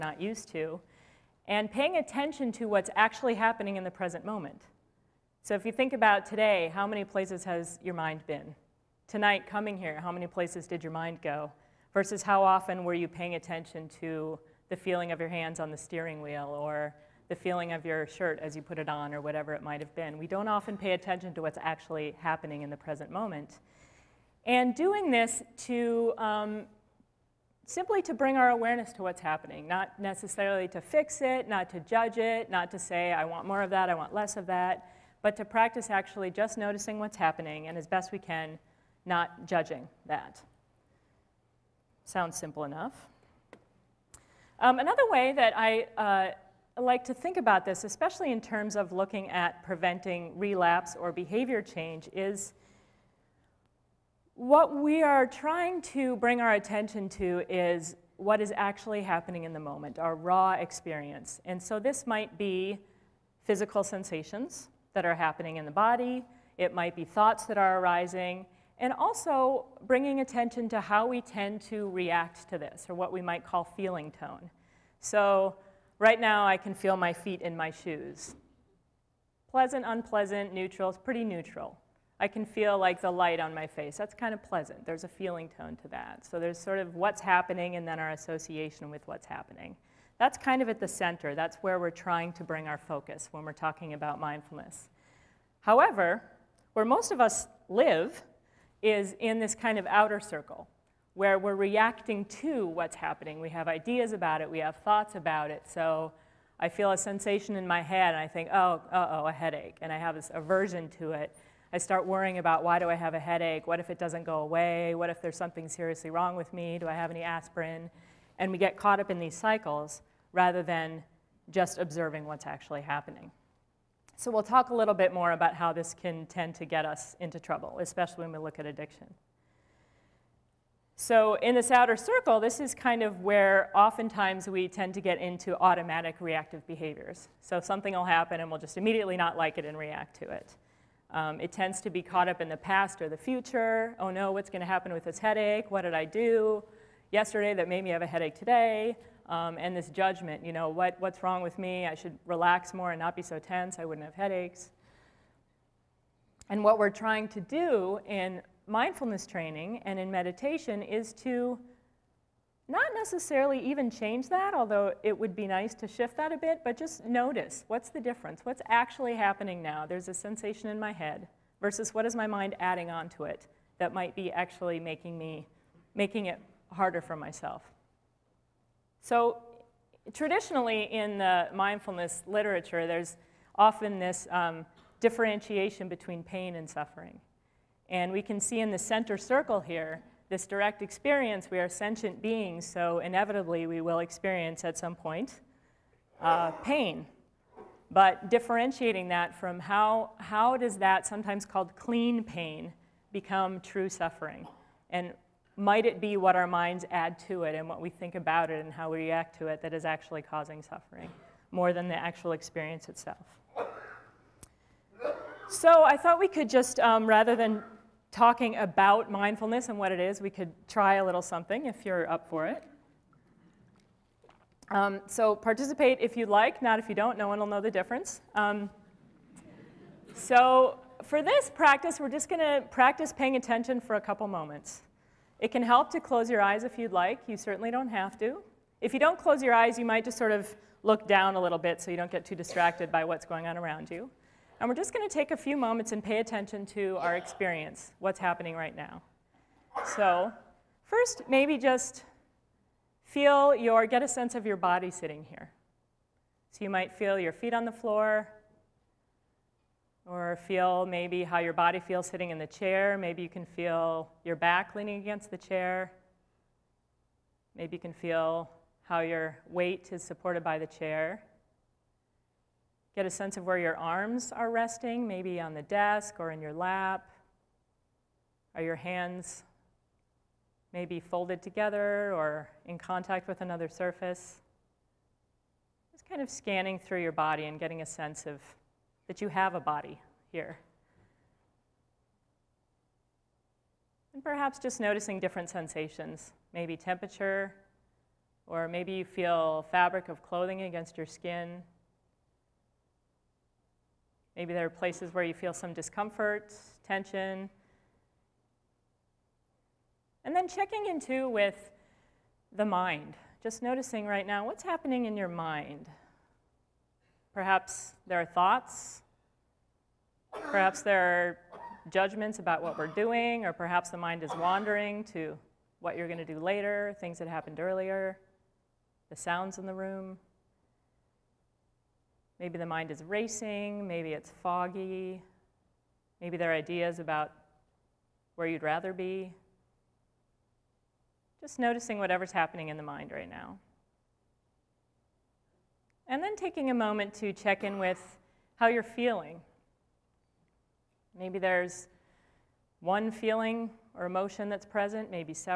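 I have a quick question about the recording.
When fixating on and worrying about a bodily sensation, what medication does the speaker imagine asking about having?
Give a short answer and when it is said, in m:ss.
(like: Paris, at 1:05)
aspirin, at 1:57.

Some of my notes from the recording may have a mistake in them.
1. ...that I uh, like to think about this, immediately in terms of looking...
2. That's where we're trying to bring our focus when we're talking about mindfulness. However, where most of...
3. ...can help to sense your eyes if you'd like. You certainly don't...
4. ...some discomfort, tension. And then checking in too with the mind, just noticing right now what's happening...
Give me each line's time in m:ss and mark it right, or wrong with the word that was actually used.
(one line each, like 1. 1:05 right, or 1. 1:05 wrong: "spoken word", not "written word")
1. 0:45 wrong: "especially", not "immediately"
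2. 1:31 right
3. 3:55 wrong: "close", not "sense"
4. 5:05 right.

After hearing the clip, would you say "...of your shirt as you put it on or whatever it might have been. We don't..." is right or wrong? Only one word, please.
right.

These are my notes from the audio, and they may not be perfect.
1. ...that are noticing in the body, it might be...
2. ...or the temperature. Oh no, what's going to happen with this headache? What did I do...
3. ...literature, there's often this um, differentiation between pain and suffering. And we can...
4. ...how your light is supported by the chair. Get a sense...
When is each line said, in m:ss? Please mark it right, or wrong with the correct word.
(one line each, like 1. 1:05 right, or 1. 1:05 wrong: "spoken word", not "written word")
1. 1:04 wrong: "happening", not "noticing"
2. 2:23 wrong: "future", not "temperature"
3. 3:02 right
4. 4:28 wrong: "weight", not "light".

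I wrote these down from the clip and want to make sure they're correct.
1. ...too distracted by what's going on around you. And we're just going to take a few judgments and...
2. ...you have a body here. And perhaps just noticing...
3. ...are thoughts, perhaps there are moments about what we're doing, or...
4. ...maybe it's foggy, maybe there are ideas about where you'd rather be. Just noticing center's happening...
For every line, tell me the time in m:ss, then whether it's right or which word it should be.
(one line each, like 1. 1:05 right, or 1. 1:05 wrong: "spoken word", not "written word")
1. 4:02 wrong: "moments", not "judgments"
2. 4:49 right
3. 5:18 wrong: "judgments", not "moments"
4. 5:33 wrong: "whatever", not "center".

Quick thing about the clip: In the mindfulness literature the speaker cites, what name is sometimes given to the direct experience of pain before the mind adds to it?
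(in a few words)
clean pain.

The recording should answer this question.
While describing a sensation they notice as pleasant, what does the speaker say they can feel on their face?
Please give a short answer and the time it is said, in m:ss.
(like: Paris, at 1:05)
the light, at 1:22.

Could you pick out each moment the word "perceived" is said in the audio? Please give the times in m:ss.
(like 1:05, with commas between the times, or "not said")
not said.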